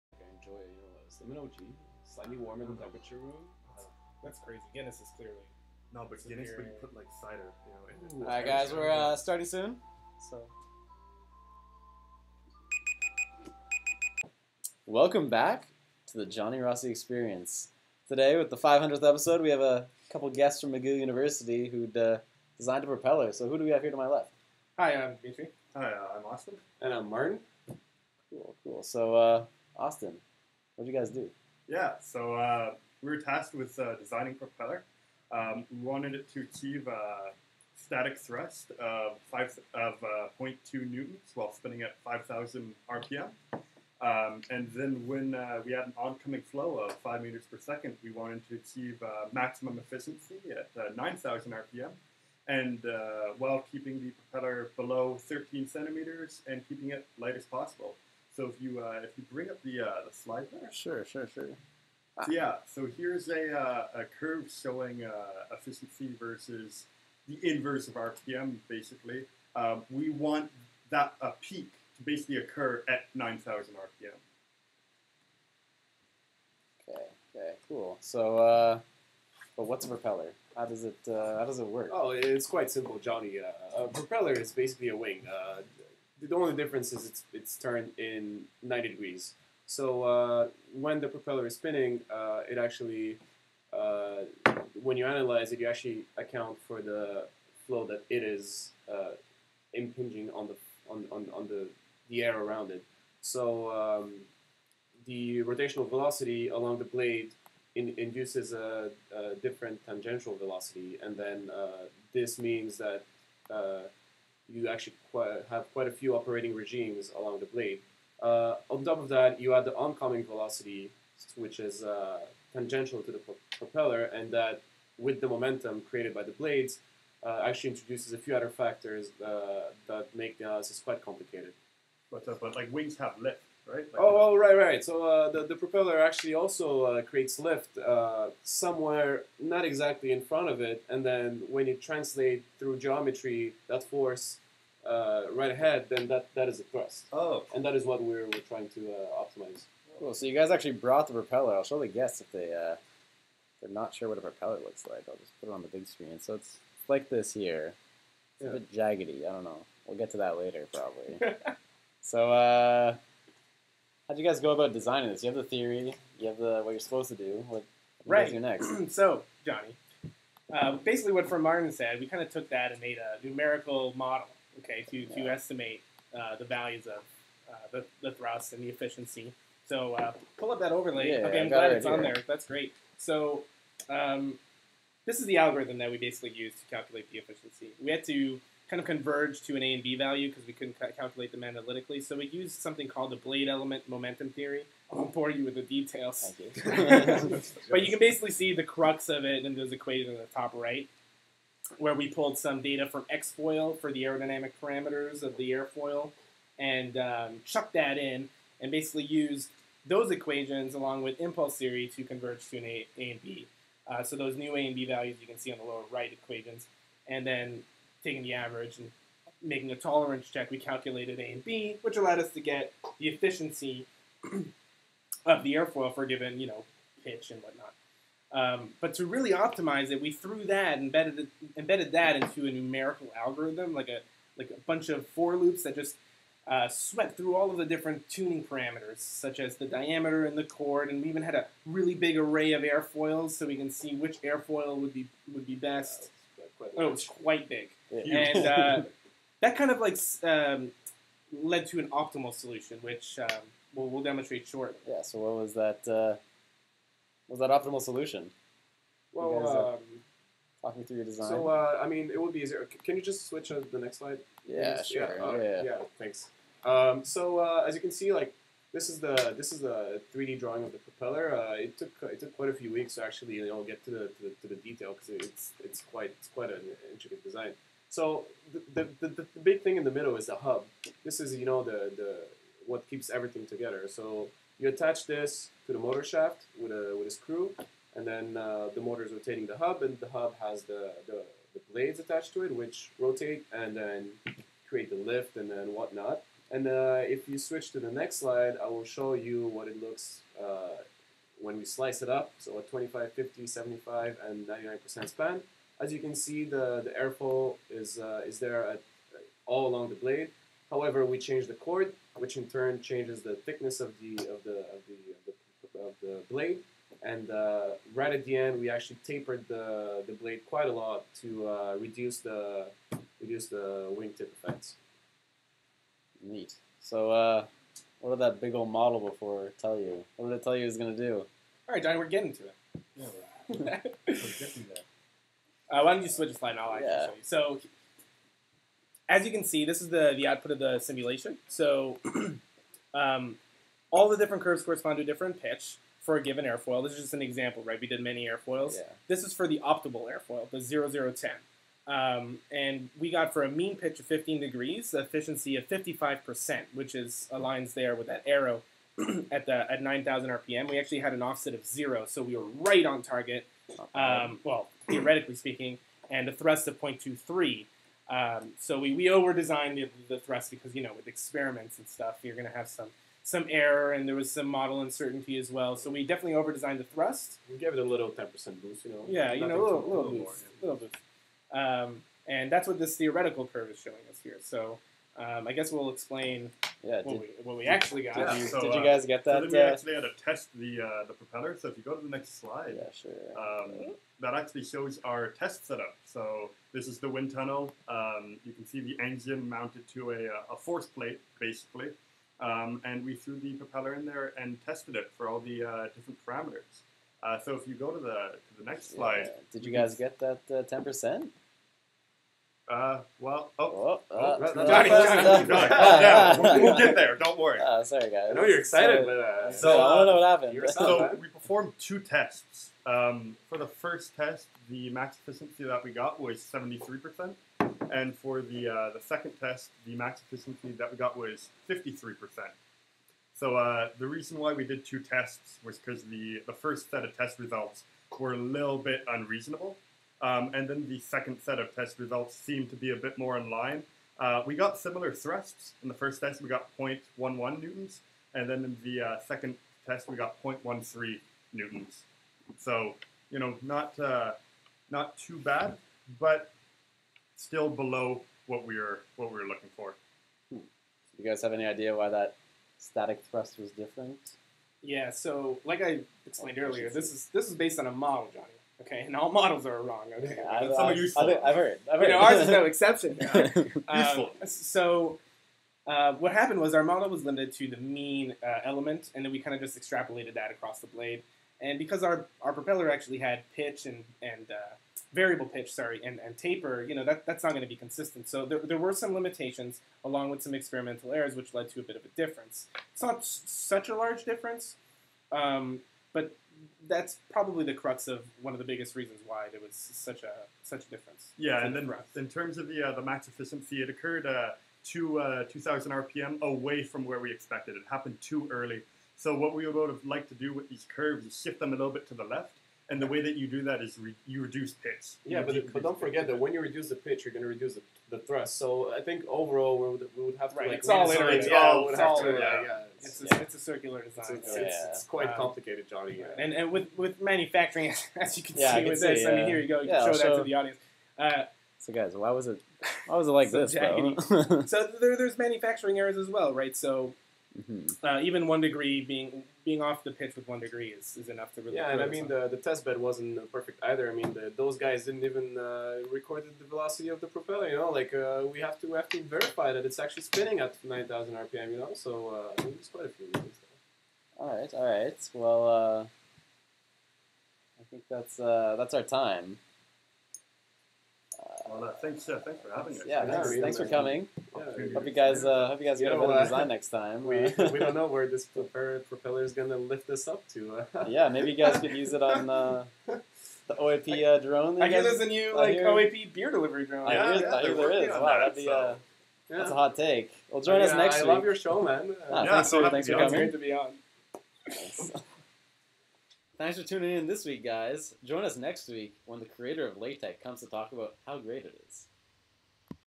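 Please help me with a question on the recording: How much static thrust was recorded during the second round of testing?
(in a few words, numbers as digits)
0.13 newtons.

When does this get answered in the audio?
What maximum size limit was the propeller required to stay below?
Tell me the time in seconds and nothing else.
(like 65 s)
55 s.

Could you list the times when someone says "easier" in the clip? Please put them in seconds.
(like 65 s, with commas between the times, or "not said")
262 s.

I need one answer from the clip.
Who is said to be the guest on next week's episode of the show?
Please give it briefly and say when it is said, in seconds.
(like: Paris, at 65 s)
creator of LaTeX, at 589 s.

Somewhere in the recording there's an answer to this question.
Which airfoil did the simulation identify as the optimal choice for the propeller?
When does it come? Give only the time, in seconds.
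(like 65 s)
350 s.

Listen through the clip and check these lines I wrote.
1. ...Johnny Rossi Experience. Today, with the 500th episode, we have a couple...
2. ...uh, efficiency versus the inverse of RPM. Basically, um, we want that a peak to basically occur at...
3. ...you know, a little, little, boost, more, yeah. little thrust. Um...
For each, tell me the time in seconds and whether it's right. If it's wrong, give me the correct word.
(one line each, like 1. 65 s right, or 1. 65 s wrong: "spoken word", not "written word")
1. 16 s right
2. 65 s right
3. 379 s wrong: "boost", not "thrust".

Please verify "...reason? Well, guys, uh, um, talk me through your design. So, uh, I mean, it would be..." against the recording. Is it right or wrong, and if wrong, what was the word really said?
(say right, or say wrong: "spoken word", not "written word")
wrong: "solution", not "reason".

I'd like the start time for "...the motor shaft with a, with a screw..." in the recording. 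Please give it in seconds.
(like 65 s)
285 s.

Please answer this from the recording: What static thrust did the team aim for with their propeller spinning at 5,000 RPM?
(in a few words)
0.2 newtons.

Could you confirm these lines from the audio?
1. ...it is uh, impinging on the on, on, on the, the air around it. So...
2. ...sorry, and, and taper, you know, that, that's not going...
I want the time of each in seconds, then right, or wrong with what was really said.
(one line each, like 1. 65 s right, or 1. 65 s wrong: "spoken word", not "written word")
1. 98 s right
2. 485 s right.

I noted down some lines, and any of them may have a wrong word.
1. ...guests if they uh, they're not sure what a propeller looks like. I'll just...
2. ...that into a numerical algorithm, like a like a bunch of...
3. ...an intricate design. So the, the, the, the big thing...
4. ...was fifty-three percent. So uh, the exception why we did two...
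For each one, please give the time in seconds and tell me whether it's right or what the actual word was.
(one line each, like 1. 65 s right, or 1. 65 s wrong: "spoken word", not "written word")
1. 151 s right
2. 231 s right
3. 276 s right
4. 431 s wrong: "reason", not "exception".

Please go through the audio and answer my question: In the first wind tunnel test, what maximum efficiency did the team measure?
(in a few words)
73%.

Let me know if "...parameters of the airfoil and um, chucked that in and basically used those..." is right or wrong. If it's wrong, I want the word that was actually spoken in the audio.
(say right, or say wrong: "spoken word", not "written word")
right.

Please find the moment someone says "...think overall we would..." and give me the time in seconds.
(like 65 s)
519 s.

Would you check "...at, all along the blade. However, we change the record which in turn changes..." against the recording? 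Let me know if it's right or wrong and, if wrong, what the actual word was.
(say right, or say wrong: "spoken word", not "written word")
wrong: "chord", not "record".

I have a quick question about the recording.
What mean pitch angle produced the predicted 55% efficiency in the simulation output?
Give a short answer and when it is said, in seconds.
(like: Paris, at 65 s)
15 degrees, at 354 s.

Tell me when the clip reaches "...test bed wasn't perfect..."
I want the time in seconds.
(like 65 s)
542 s.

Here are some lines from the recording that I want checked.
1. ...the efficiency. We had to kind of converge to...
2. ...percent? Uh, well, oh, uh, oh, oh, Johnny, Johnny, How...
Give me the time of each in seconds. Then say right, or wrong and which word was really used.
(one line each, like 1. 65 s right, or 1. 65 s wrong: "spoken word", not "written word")
1. 187 s right
2. 410 s wrong: "Johnny", not "How".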